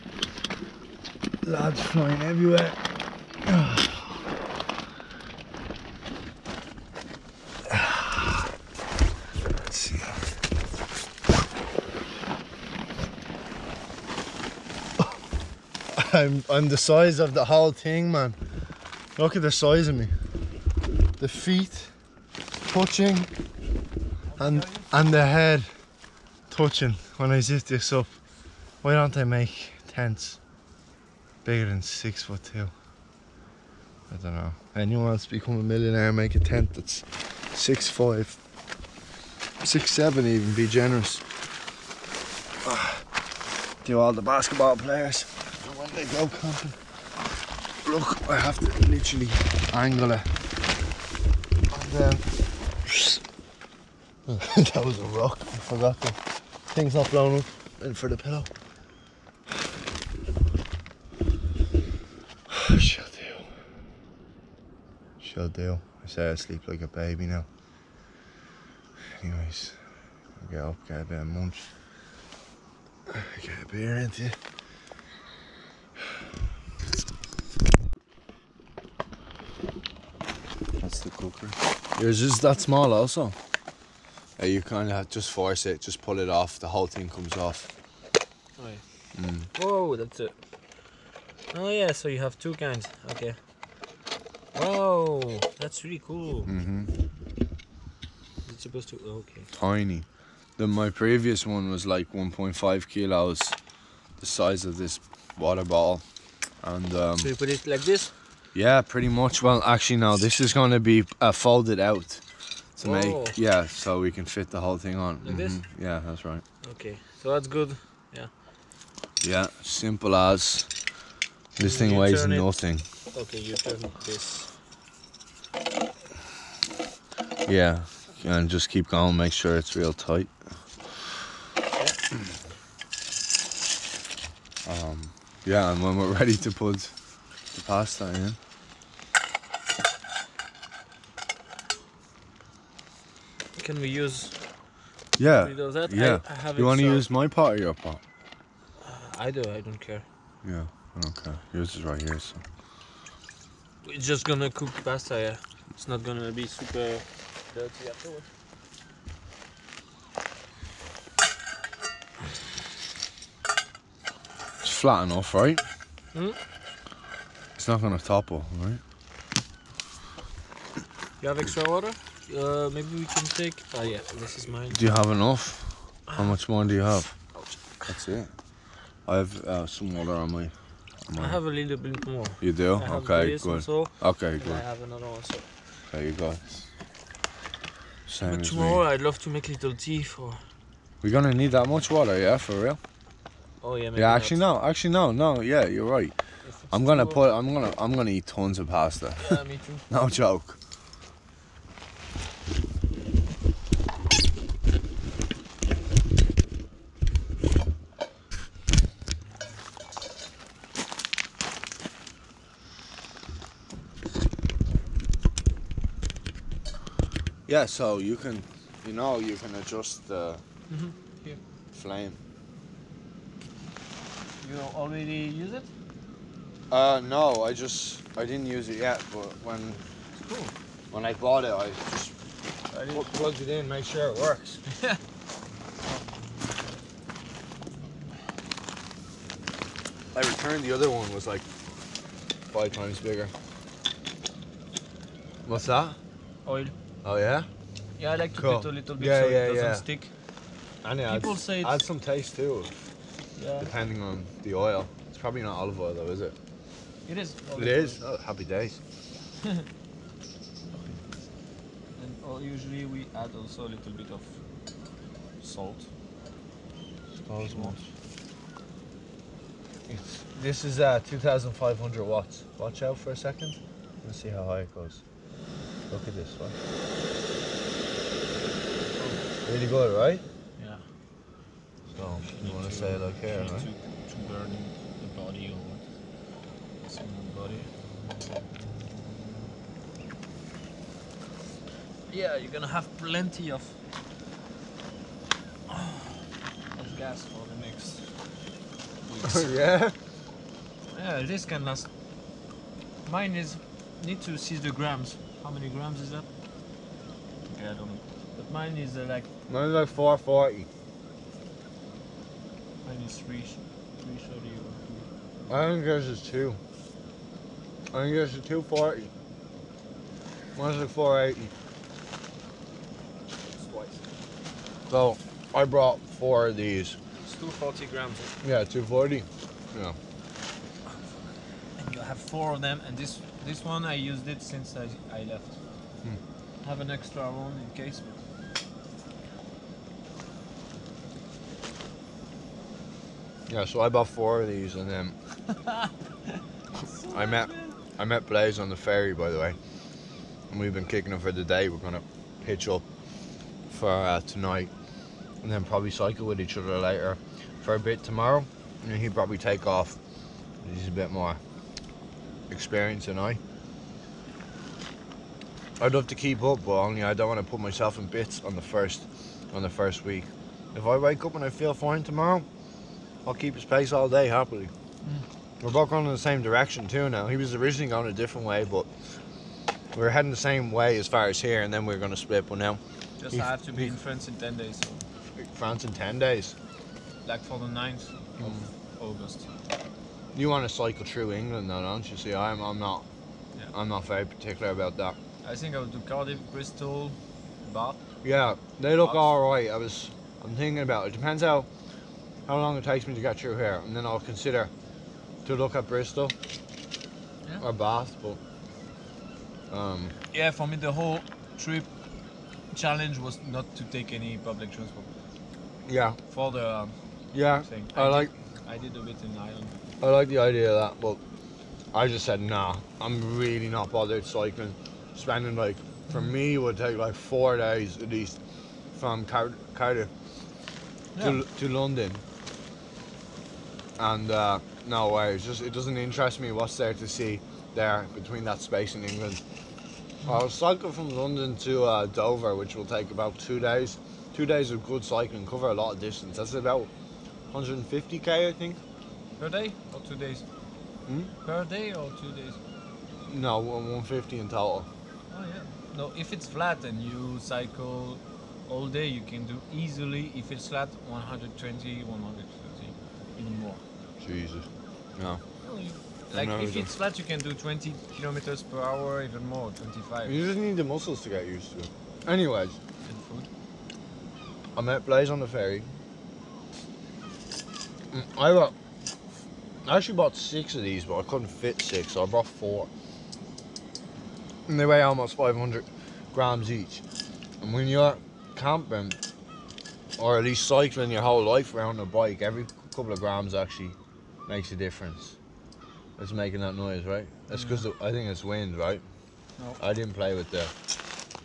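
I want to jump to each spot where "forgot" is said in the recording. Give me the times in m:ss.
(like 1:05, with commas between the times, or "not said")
0:55.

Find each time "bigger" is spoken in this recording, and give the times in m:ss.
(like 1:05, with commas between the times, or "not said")
0:31, 4:02.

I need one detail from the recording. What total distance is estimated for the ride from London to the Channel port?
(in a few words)
150 km.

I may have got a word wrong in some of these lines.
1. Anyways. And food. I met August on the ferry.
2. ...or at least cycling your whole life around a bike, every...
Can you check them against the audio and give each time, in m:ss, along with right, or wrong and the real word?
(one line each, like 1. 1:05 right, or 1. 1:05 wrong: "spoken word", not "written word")
1. 7:52 wrong: "Blaze", not "August"
2. 8:10 right.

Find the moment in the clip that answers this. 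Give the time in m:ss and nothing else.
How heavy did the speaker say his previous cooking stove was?
1:42.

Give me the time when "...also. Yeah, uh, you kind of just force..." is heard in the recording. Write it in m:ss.
1:22.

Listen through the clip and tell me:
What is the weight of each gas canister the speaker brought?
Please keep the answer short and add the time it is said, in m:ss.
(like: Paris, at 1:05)
240 grams, at 5:27.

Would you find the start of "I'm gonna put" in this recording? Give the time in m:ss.
3:16.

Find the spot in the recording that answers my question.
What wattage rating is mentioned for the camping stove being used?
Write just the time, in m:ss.
4:31.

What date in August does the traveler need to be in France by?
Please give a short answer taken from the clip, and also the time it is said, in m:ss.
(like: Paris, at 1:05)
9th of August, at 6:27.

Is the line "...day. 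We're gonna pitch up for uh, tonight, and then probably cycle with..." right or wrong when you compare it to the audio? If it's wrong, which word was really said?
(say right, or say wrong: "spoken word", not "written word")
right.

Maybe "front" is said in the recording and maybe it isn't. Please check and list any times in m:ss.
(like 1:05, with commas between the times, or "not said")
not said.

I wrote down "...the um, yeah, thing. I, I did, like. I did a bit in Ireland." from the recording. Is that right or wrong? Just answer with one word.
right.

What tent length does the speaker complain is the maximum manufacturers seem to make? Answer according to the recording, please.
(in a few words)
6 foot 2.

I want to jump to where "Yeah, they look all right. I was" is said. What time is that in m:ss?
6:38.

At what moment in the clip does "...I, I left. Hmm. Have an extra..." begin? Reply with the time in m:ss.
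5:34.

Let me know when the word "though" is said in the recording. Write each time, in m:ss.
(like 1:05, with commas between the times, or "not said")
4:15, 6:31.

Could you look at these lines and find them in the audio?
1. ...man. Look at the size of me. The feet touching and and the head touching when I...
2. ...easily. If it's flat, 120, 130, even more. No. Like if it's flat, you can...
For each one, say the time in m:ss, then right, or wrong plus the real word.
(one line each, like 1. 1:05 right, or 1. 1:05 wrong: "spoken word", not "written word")
1. 0:18 right
2. 7:39 right.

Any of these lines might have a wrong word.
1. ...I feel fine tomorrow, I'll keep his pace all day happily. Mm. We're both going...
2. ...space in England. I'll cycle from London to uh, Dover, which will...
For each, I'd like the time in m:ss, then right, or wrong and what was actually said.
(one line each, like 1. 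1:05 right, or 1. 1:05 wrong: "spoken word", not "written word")
1. 6:11 right
2. 7:18 right.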